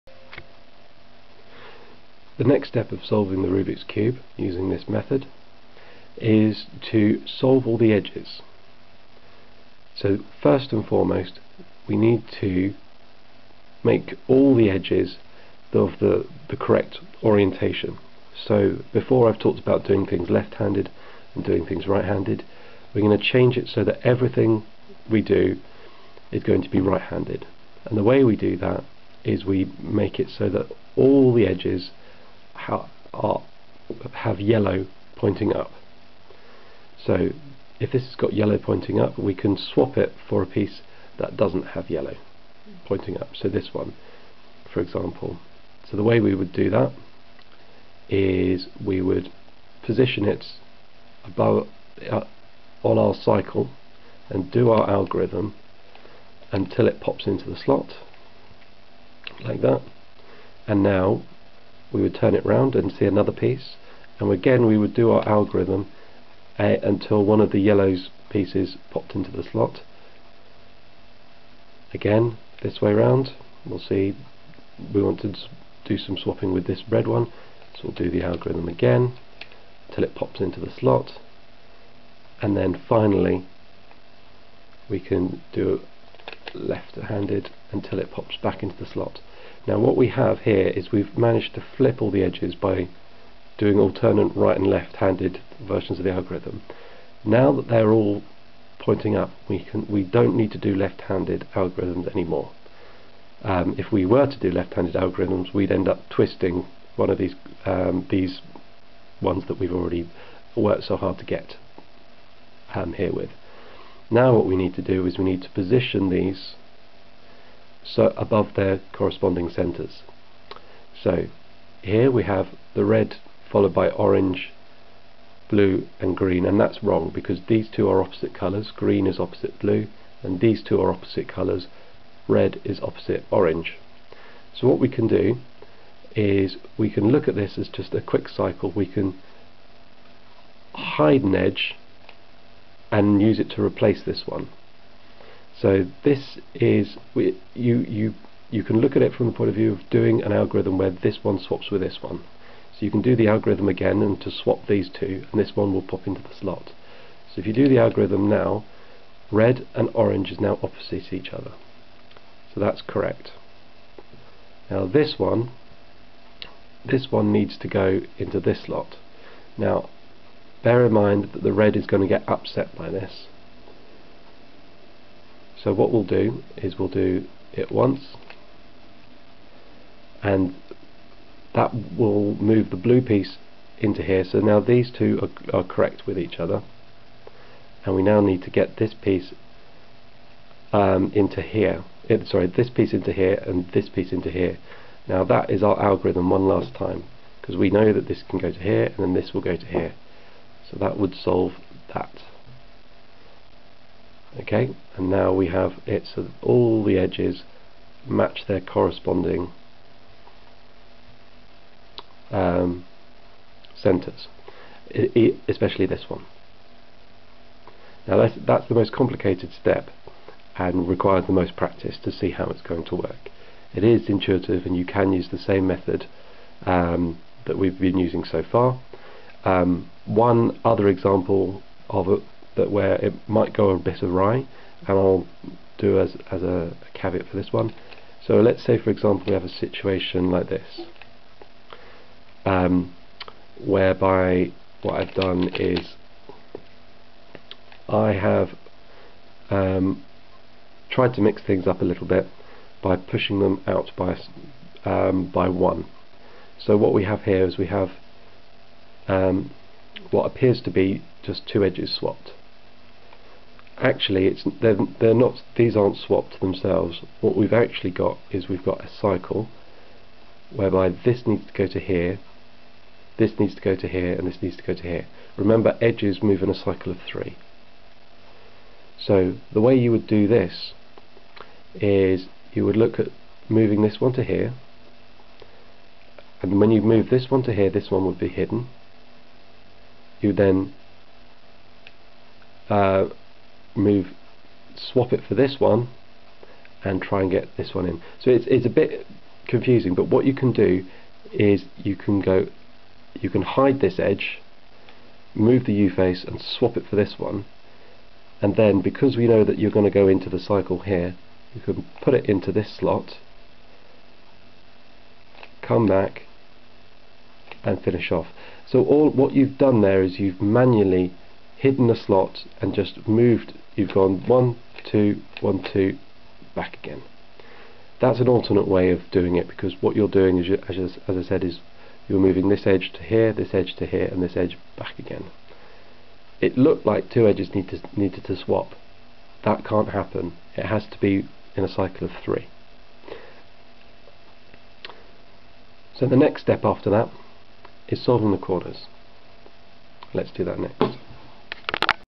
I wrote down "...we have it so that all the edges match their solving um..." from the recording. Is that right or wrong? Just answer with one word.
wrong.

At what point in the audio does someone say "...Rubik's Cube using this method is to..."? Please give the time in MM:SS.
00:03.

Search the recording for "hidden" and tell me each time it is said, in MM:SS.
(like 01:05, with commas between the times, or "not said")
04:48, 05:21.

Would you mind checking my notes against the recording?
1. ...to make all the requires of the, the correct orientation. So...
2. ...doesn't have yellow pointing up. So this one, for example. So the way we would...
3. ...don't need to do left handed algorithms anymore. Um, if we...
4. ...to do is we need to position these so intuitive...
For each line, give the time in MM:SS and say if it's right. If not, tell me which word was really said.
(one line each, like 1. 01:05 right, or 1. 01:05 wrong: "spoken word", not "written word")
1. 00:12 wrong: "edges", not "requires"
2. 00:41 right
3. 01:40 right
4. 01:54 wrong: "above", not "intuitive".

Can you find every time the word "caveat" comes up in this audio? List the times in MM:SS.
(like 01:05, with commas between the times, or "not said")
03:56.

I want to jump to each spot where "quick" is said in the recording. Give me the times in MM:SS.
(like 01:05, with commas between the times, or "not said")
02:18.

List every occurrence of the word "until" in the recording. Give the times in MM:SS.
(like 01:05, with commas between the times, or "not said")
00:56, 01:06, 01:19, 01:27.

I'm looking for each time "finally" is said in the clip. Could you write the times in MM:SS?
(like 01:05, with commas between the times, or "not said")
01:22.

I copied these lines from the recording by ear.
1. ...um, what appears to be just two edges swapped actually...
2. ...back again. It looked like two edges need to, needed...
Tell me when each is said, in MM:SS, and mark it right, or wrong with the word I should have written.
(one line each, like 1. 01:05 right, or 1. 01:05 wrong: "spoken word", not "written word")
1. 04:19 right
2. 05:34 right.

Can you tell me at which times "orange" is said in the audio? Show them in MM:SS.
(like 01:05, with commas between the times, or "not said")
02:03, 02:13, 02:39.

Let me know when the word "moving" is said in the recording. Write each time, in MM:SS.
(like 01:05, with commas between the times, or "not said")
04:43, 05:32.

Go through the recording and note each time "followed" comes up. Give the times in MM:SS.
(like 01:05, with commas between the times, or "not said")
02:03.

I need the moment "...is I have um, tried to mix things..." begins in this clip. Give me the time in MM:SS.
04:05.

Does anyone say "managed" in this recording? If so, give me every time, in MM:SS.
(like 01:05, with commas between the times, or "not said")
01:31.